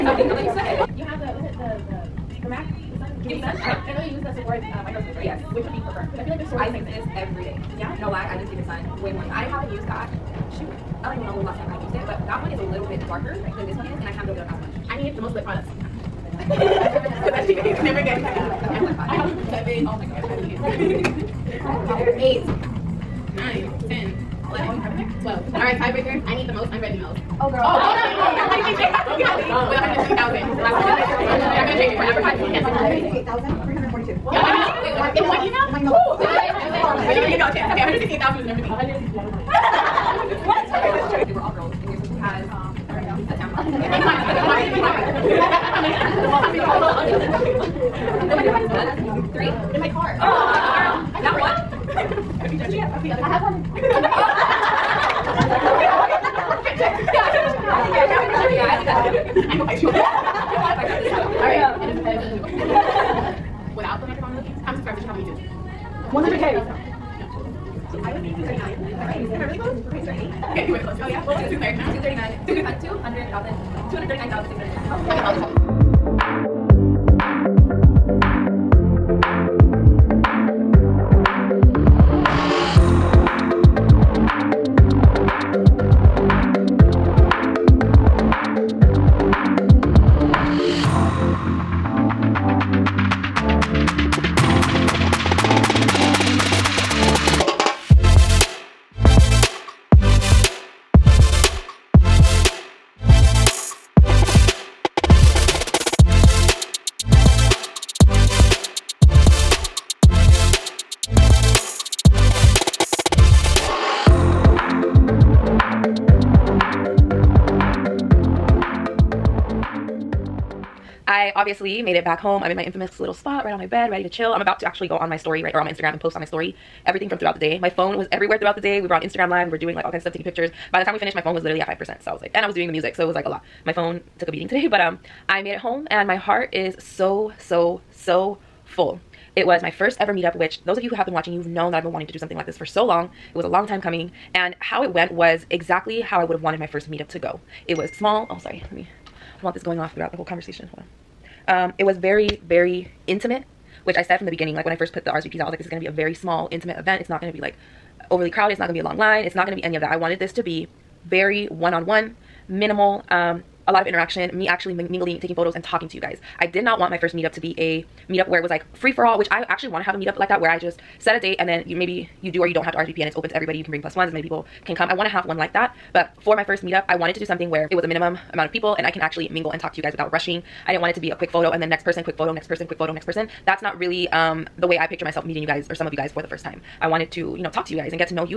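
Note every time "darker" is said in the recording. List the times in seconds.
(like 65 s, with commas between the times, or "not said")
13 s.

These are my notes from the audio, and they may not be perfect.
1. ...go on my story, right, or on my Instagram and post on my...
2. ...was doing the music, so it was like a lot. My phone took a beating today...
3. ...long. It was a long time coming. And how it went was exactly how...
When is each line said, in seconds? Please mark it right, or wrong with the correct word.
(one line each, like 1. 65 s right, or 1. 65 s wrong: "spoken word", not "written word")
1. 124 s right
2. 132 s right
3. 142 s right.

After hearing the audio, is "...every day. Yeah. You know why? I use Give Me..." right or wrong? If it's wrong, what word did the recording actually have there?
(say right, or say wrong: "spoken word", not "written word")
right.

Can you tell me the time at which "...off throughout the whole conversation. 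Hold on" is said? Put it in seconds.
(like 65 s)
149 s.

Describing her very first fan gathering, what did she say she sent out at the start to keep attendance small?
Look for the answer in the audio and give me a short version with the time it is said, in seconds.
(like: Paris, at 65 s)
RSVPs, at 155 s.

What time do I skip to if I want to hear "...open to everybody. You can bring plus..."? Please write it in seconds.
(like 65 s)
173 s.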